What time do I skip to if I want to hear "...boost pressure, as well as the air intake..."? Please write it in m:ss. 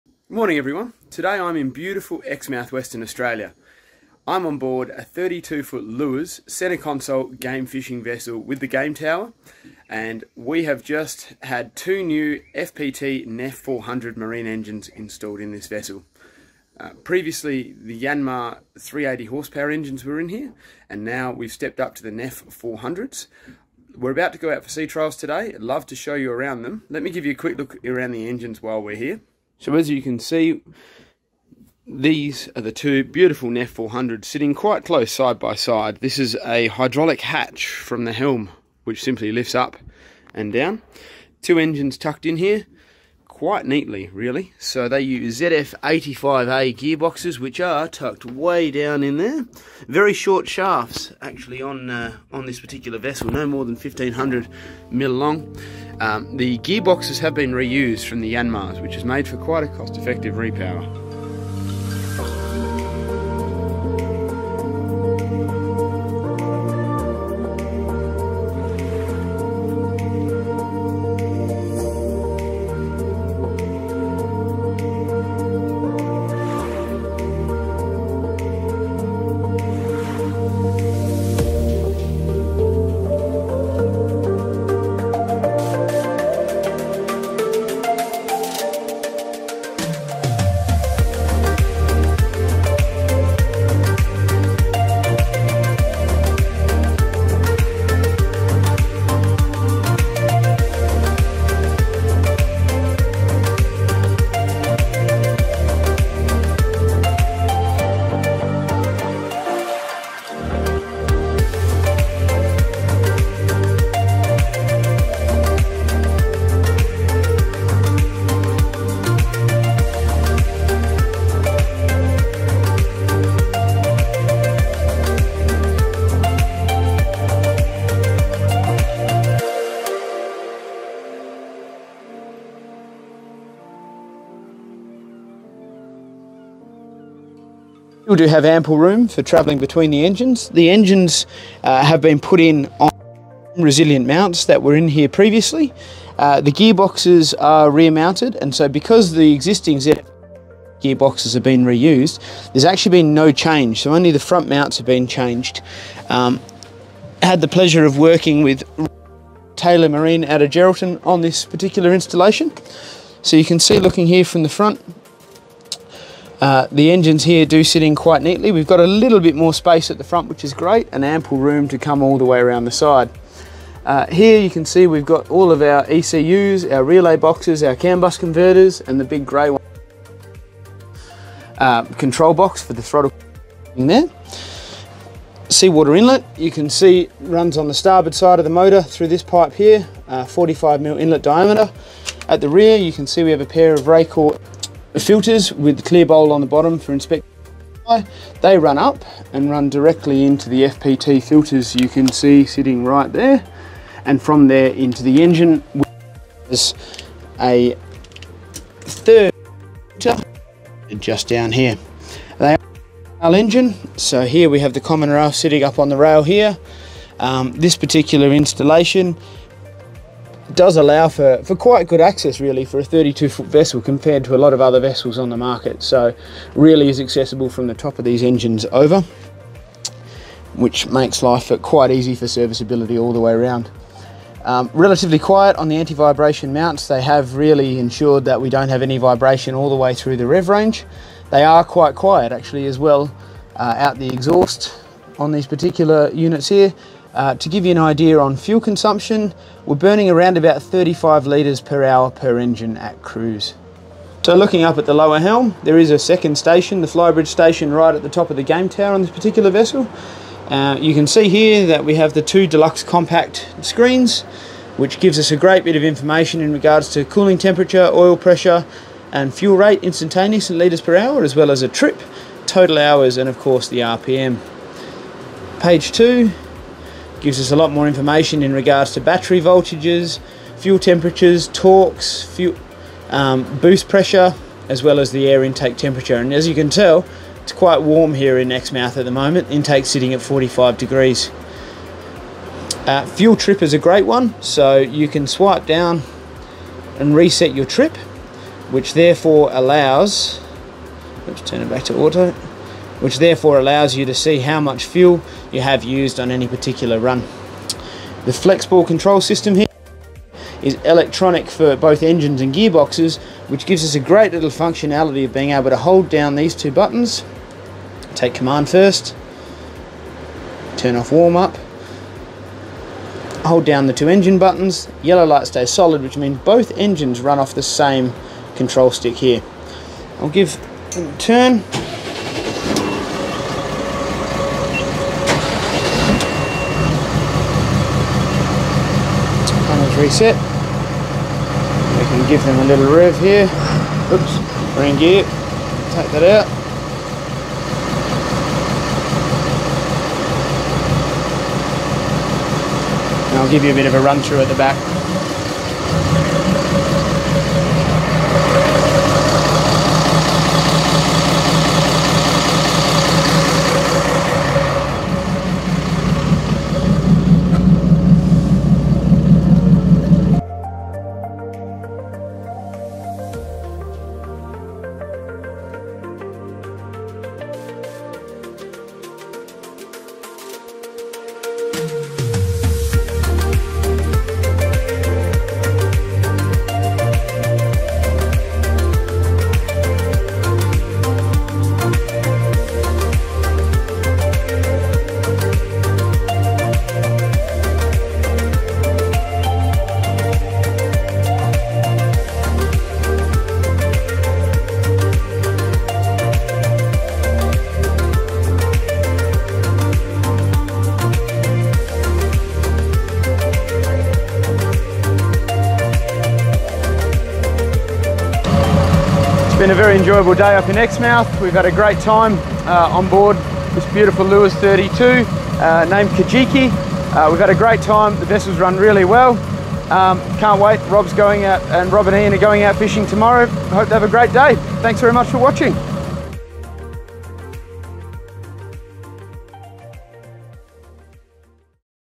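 4:43.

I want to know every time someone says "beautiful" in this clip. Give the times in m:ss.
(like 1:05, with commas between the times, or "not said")
0:01, 0:33, 7:03.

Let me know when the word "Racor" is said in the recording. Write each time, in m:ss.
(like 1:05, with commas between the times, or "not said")
3:13.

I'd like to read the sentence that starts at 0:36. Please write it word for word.
This is a hydraulic hatch from the helm, which simply lifts up and down.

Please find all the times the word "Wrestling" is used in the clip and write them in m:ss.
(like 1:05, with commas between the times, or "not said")
not said.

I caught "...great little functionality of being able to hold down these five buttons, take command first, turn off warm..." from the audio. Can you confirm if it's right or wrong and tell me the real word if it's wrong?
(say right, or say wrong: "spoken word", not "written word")
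wrong: "two", not "five".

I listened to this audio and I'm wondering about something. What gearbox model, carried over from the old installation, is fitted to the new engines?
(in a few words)
ZF85A.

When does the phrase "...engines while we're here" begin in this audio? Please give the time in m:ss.
0:28.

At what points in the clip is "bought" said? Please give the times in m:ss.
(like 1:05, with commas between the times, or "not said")
not said.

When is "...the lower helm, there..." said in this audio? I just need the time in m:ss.
4:14.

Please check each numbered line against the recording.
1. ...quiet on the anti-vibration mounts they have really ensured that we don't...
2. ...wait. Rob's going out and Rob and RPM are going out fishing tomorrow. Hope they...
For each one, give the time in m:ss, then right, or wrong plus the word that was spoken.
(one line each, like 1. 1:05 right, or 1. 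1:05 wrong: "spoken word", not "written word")
1. 3:55 right
2. 7:10 wrong: "Ian", not "RPM".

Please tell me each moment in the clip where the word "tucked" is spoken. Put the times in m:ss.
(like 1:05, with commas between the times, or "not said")
0:41, 0:47.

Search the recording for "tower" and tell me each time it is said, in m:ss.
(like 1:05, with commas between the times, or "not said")
0:08, 4:18.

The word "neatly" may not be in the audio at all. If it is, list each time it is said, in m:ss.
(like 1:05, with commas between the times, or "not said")
0:43, 2:48.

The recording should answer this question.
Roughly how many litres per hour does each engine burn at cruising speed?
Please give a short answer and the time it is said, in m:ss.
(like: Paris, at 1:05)
35, at 4:10.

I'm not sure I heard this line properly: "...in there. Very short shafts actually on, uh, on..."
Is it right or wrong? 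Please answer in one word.
right.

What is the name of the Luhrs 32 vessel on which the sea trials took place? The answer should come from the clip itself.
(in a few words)
Kajiki.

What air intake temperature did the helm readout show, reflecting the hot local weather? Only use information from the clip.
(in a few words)
45 degrees.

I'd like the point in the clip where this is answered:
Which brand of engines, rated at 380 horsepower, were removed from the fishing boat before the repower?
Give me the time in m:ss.
0:18.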